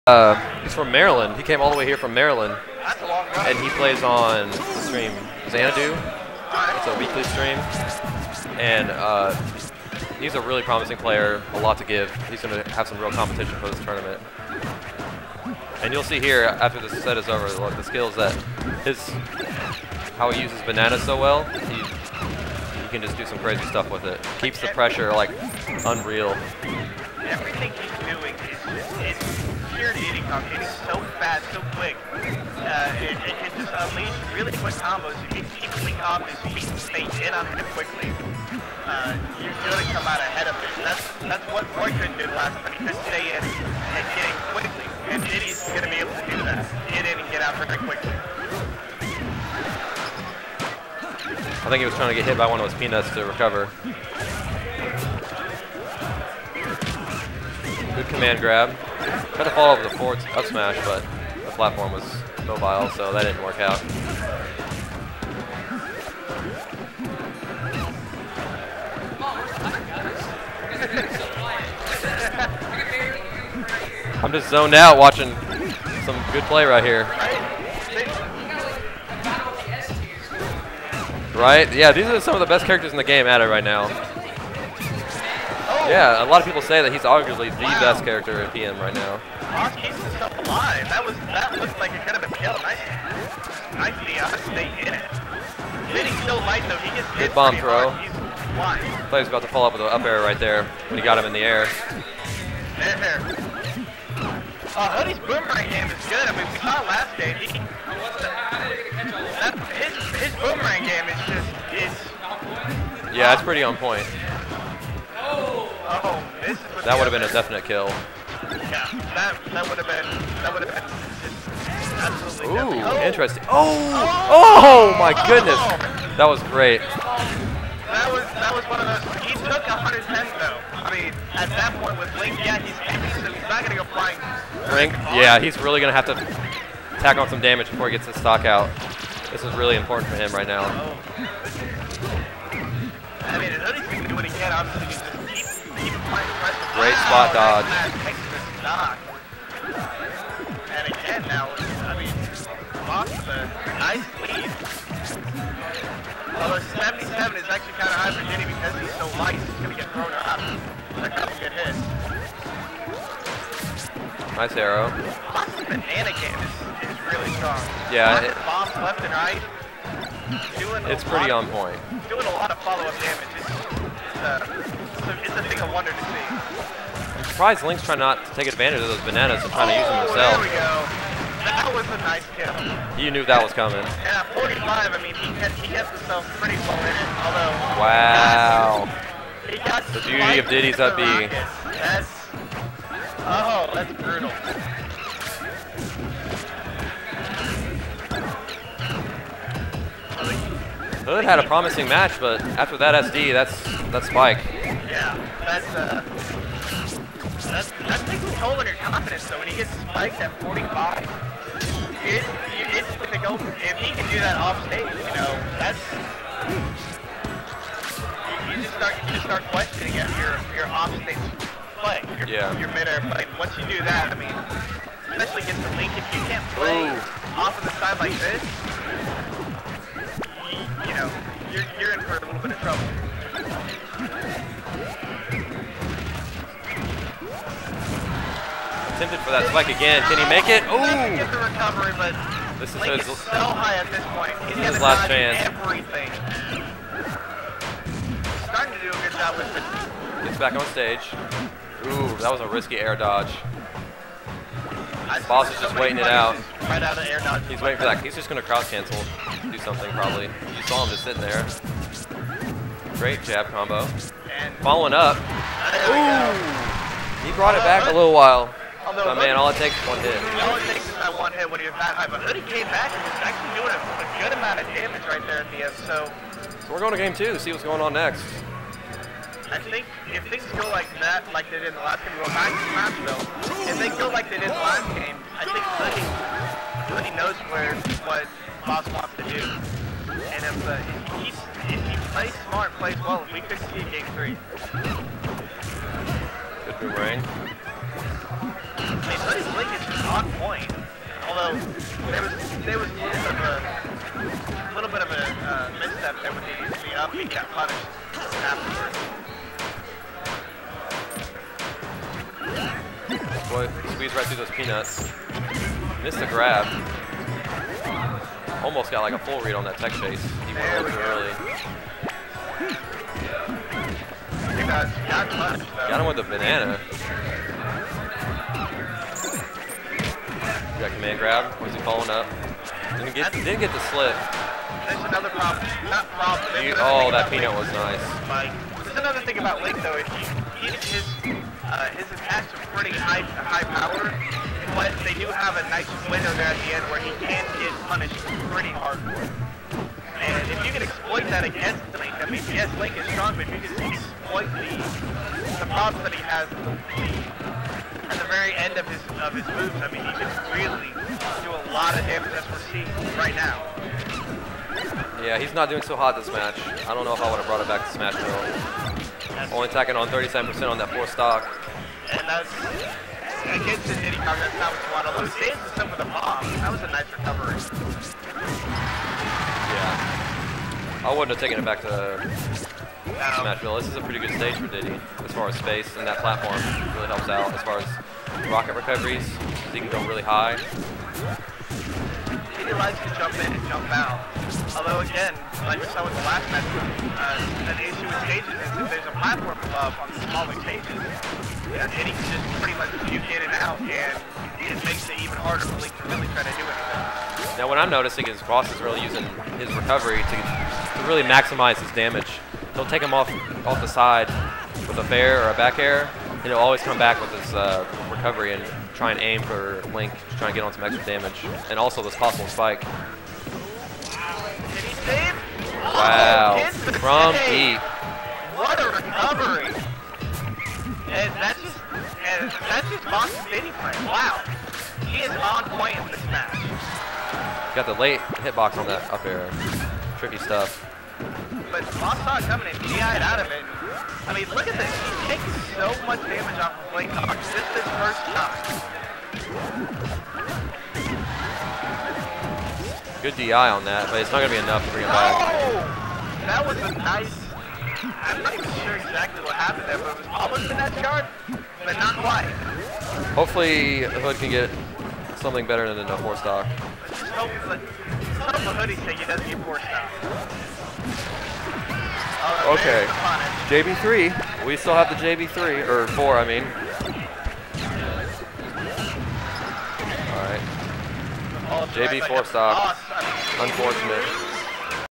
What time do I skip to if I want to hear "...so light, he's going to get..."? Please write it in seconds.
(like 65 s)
158 s.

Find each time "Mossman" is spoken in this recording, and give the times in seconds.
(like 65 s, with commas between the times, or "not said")
152 s, 165 s.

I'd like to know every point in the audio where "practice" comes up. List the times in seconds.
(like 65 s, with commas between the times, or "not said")
not said.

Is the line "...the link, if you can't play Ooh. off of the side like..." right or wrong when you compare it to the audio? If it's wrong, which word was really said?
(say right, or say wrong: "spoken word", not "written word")
right.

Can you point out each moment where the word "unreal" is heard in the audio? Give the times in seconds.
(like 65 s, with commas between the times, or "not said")
25 s.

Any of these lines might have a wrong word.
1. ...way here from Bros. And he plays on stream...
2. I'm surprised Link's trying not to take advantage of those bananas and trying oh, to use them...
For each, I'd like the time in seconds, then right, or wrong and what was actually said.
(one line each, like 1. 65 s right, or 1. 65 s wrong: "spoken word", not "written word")
1. 1 s wrong: "Maryland", not "Bros"
2. 177 s right.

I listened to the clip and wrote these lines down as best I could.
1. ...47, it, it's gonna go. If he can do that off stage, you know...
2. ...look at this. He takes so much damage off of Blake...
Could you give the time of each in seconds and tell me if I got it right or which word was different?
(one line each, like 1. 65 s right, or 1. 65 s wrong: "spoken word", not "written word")
1. 210 s wrong: "45", not "47"
2. 444 s right.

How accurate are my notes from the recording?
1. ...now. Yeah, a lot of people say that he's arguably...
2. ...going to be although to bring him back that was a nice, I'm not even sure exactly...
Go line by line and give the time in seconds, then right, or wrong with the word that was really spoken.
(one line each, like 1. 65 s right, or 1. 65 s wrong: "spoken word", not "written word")
1. 83 s right
2. 454 s wrong: "enough", not "although".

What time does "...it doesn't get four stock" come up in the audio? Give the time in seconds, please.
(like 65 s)
469 s.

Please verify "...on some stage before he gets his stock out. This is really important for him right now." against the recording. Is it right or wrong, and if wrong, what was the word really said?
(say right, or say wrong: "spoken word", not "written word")
wrong: "damage", not "stage".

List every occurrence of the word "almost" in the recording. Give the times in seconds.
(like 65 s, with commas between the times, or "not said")
318 s, 460 s.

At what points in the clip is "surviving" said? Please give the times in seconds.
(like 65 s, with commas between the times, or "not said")
not said.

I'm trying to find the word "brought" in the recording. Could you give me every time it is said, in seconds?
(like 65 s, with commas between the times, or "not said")
267 s, 367 s.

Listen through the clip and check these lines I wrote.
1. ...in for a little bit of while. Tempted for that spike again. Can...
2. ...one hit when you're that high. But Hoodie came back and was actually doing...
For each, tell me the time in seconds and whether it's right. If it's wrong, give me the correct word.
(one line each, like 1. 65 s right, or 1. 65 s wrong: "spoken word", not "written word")
1. 231 s wrong: "trouble", not "while"
2. 271 s right.